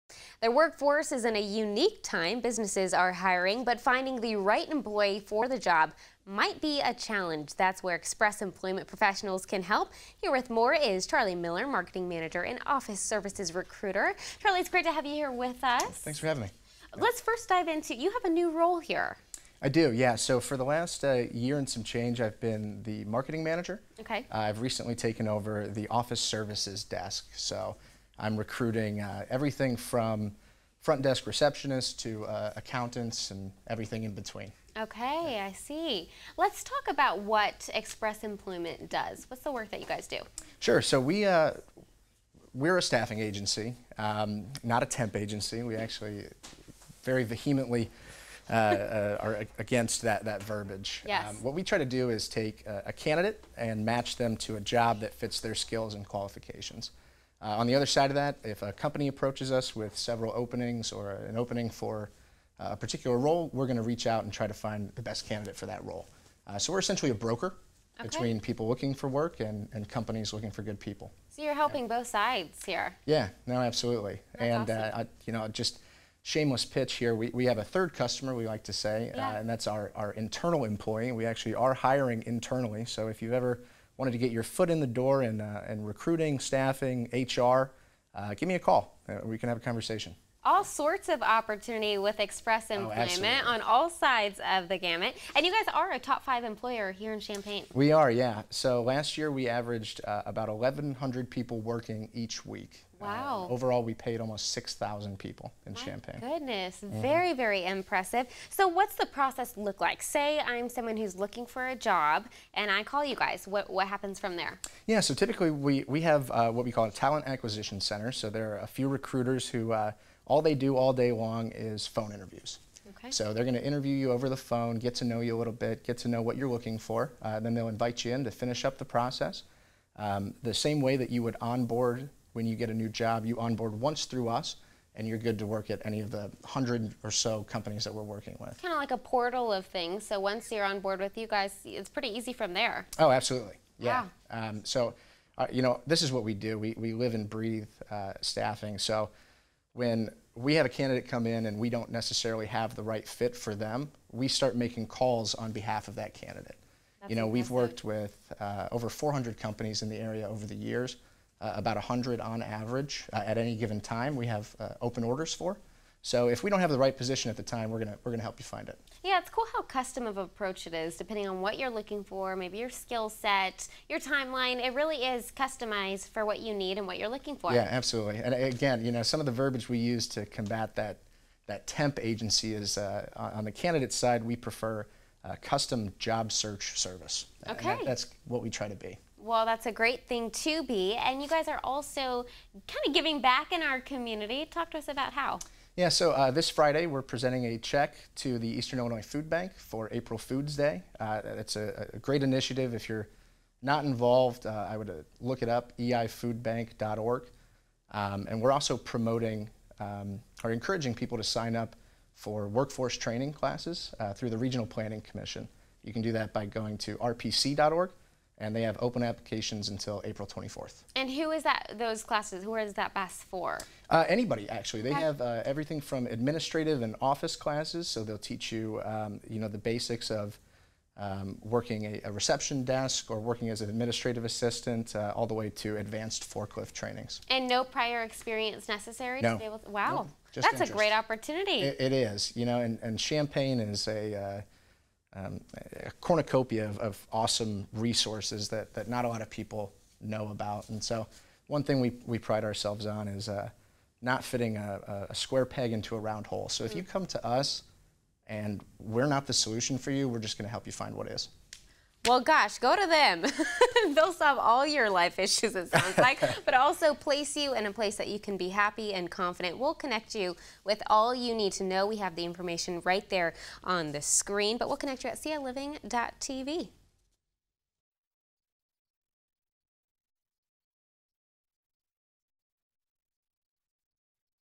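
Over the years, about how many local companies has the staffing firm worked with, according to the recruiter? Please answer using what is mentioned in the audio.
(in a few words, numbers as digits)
400.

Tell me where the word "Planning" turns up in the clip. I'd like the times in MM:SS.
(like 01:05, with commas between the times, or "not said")
03:34.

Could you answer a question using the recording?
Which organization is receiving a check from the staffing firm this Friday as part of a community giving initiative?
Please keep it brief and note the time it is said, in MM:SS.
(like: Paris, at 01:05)
Eastern Illinois Food Bank, at 03:18.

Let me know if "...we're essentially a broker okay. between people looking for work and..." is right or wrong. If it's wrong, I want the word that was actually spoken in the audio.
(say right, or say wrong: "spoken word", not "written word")
right.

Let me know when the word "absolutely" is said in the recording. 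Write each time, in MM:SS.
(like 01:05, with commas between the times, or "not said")
01:13, 02:23, 02:57.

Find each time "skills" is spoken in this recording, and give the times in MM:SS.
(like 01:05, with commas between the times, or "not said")
00:55, 02:52.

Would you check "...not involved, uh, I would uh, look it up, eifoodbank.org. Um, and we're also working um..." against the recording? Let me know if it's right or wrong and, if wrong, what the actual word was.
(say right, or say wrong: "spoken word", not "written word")
wrong: "promoting", not "working".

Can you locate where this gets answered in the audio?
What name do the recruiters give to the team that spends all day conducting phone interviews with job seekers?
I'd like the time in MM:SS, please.
01:56.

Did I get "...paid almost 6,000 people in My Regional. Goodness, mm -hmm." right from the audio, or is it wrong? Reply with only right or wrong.
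wrong.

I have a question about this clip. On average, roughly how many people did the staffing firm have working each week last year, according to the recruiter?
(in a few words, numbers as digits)
1,100.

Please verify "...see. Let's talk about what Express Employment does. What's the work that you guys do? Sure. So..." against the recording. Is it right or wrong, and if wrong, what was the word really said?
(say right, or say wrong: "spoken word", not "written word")
right.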